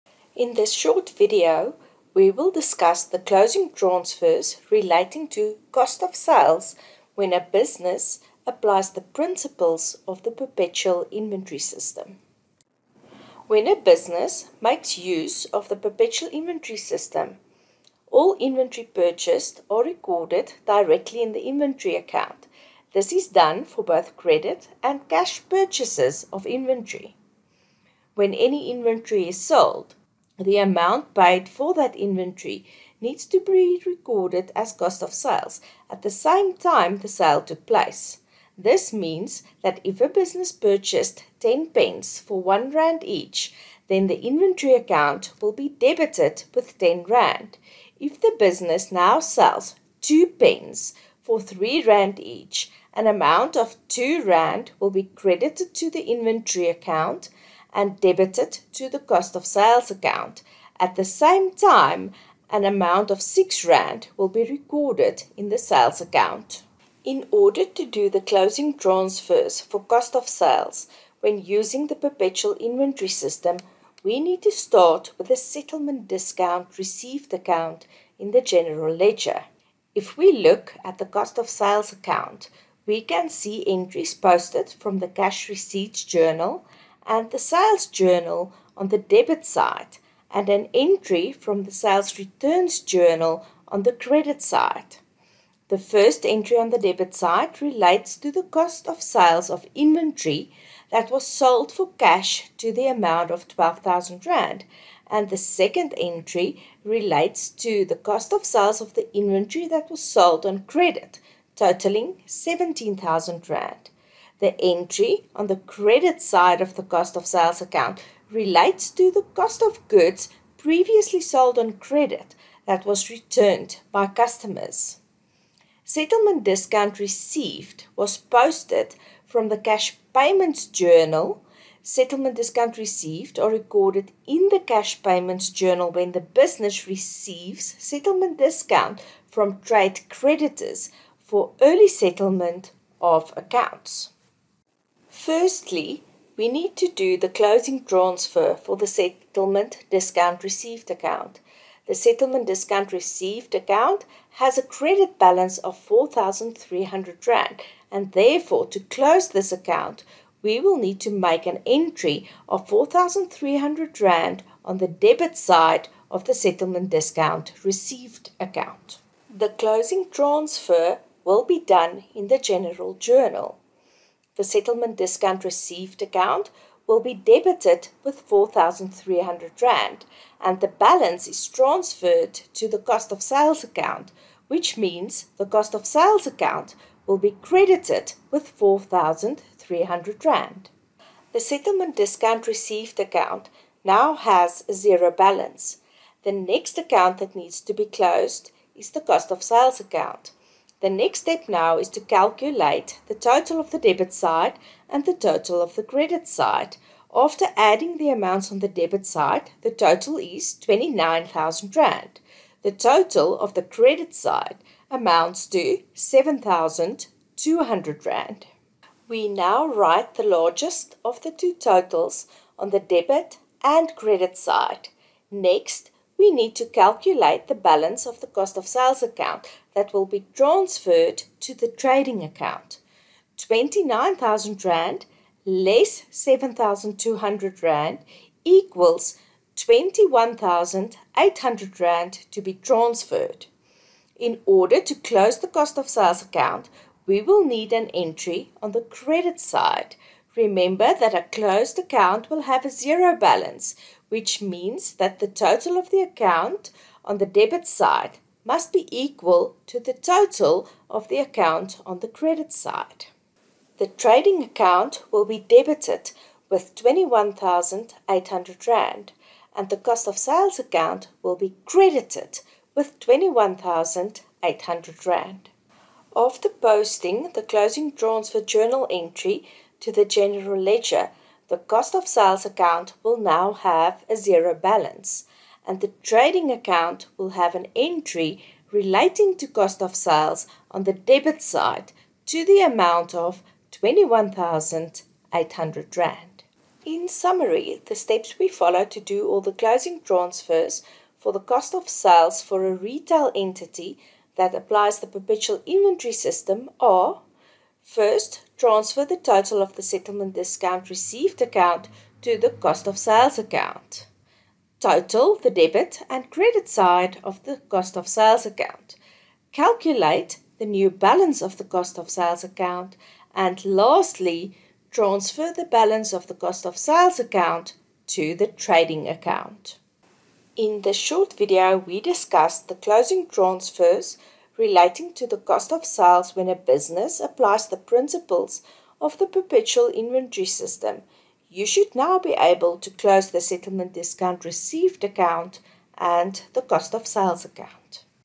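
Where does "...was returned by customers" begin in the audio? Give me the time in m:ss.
2:02.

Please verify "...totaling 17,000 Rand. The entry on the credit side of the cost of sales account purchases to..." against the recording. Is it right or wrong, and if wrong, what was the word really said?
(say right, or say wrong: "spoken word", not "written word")
wrong: "relates", not "purchases".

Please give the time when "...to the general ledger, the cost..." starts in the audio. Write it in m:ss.
4:39.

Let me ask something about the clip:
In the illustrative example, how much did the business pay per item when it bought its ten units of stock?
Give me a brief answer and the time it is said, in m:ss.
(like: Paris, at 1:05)
1 rand, at 0:42.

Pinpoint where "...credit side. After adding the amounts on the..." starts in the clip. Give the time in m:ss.
3:25.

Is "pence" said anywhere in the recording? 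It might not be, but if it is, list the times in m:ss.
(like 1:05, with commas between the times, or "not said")
0:41, 0:50.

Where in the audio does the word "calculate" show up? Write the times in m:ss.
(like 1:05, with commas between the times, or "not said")
3:22, 3:46, 5:19.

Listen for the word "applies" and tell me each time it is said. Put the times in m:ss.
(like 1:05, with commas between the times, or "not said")
0:08, 5:04, 5:37.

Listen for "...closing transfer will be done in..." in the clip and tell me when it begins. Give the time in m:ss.
2:49.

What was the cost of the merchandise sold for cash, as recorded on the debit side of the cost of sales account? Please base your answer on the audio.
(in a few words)
12,000 Rand.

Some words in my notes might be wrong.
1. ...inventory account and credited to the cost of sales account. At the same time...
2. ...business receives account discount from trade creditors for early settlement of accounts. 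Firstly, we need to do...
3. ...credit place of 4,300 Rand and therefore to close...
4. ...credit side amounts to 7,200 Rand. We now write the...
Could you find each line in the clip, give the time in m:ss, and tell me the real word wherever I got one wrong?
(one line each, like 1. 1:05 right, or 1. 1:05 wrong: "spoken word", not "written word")
1. 0:56 wrong: "debited", not "credited"
2. 2:16 wrong: "settlement", not "account"
3. 2:34 wrong: "balance", not "place"
4. 3:33 right.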